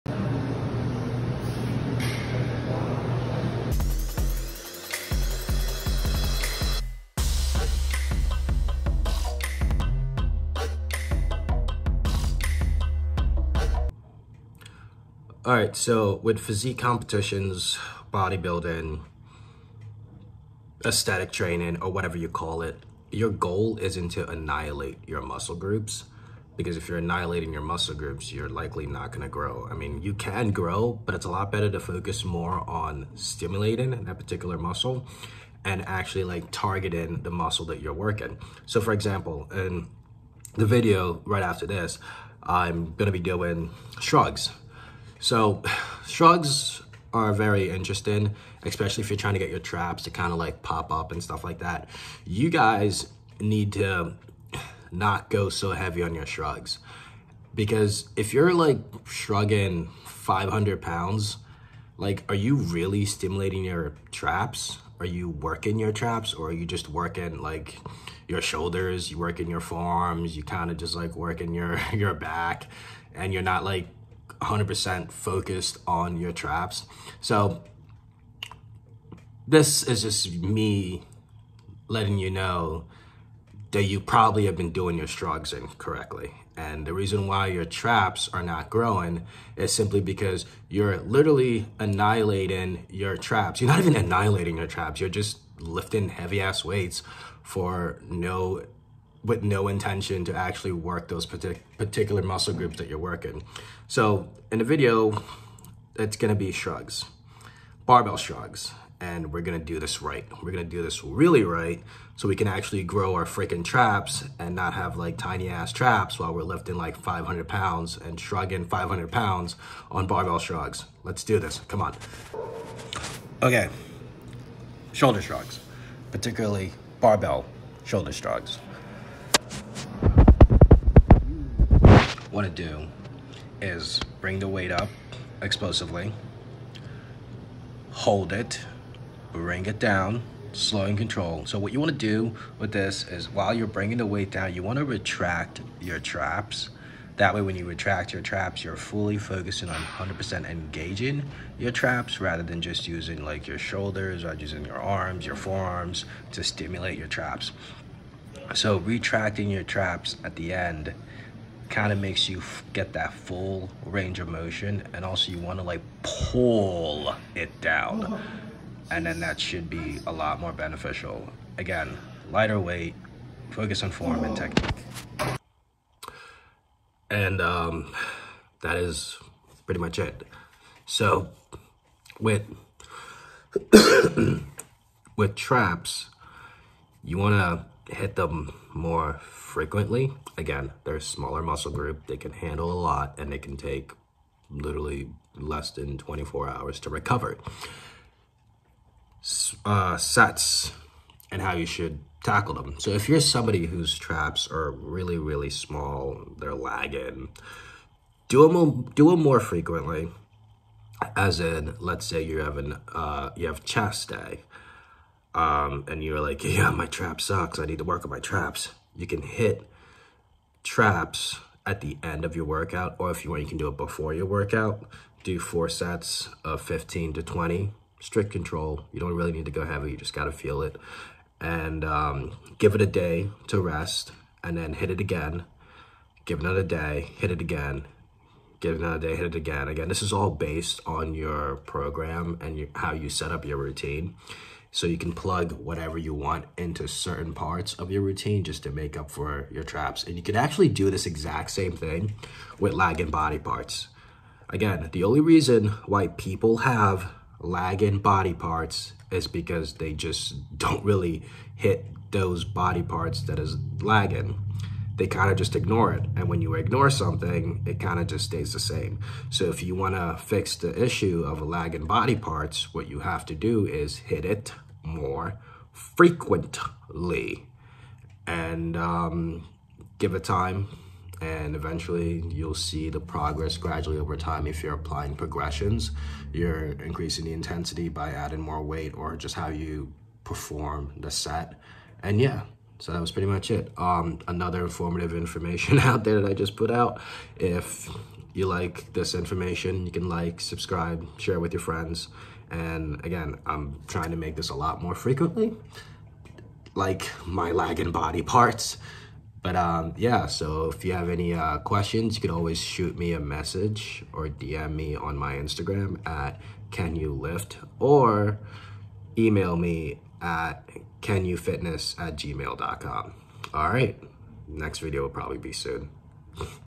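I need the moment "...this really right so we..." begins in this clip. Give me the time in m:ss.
1:50.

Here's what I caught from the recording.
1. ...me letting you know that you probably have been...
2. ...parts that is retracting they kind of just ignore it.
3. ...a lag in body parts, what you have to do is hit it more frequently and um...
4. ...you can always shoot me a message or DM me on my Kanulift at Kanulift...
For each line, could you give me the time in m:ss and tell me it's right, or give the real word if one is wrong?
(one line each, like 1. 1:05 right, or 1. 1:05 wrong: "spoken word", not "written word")
1. 1:20 right
2. 4:22 wrong: "lagging", not "retracting"
3. 4:31 right
4. 5:12 wrong: "Instagram", not "Kanulift".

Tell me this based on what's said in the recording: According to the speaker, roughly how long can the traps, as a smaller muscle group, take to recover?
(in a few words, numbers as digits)
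less than 24 hours.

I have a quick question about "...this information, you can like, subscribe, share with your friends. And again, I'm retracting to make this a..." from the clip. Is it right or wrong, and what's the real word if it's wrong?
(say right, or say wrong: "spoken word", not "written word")
wrong: "trying", not "retracting".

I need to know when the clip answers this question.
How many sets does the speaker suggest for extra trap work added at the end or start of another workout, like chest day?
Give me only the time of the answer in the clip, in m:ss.
3:45.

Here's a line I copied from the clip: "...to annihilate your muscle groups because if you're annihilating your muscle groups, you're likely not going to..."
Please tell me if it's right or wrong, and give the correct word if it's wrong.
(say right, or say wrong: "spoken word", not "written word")
right.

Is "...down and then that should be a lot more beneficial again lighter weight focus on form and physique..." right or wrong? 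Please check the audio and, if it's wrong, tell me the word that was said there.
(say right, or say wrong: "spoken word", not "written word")
wrong: "technique", not "physique".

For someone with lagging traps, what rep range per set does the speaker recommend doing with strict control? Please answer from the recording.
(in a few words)
15 to 20.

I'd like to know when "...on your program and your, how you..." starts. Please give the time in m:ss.
4:00.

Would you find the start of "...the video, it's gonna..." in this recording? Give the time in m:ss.
1:44.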